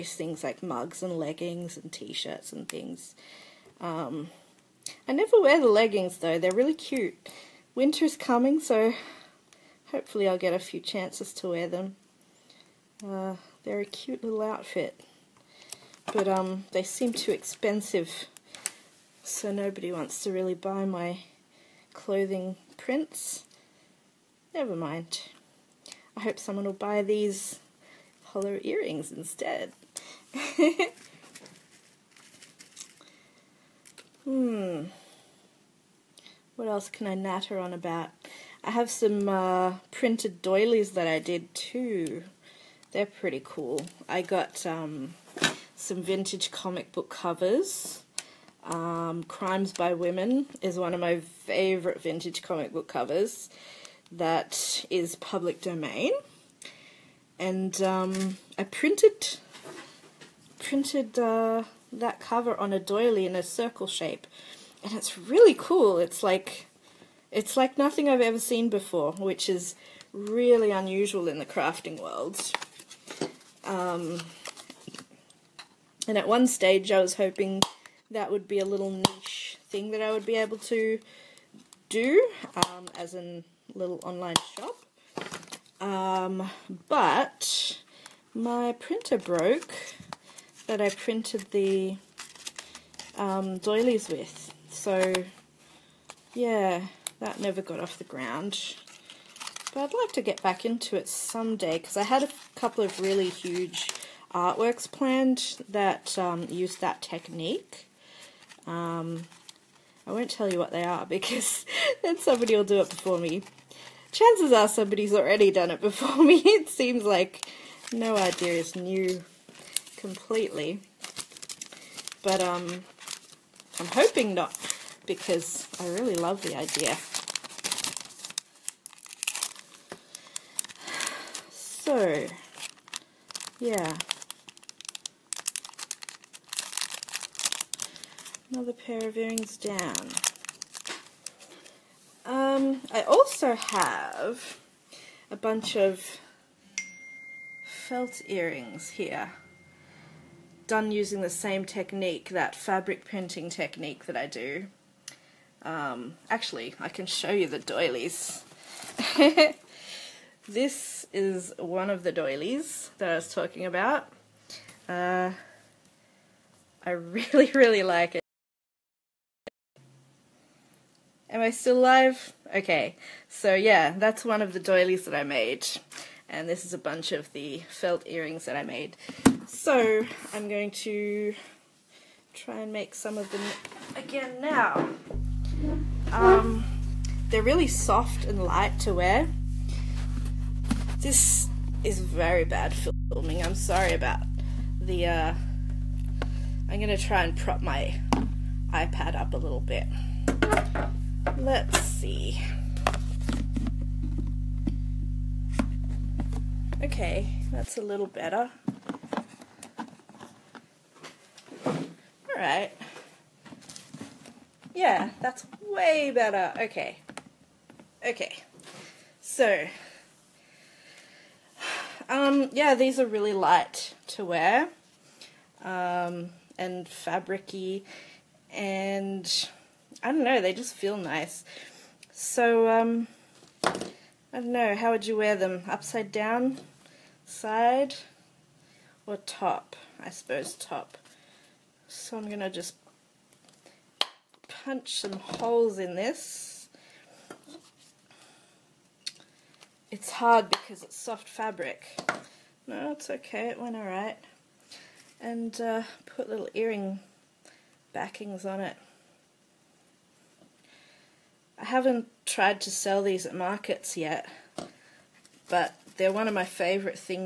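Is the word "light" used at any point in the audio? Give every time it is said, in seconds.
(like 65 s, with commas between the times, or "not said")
188 s, 223 s.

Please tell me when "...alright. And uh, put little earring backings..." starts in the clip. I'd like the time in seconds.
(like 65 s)
253 s.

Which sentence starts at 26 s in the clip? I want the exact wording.
I hope someone will buy these hollow earrings instead.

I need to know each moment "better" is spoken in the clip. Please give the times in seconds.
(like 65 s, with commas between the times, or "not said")
208 s, 216 s.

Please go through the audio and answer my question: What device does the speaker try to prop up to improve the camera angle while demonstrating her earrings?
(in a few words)
iPad.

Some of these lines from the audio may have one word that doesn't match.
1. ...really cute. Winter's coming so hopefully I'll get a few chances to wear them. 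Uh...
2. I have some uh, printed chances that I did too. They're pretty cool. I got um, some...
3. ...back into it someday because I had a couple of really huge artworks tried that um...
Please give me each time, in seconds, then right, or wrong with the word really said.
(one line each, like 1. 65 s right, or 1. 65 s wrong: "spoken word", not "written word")
1. 6 s right
2. 38 s wrong: "doilies", not "chances"
3. 100 s wrong: "planned", not "tried".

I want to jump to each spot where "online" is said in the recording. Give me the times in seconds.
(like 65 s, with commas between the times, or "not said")
84 s.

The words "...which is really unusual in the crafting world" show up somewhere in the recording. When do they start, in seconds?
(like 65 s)
69 s.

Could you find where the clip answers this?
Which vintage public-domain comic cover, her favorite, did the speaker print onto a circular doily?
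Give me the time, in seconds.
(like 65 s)
49 s.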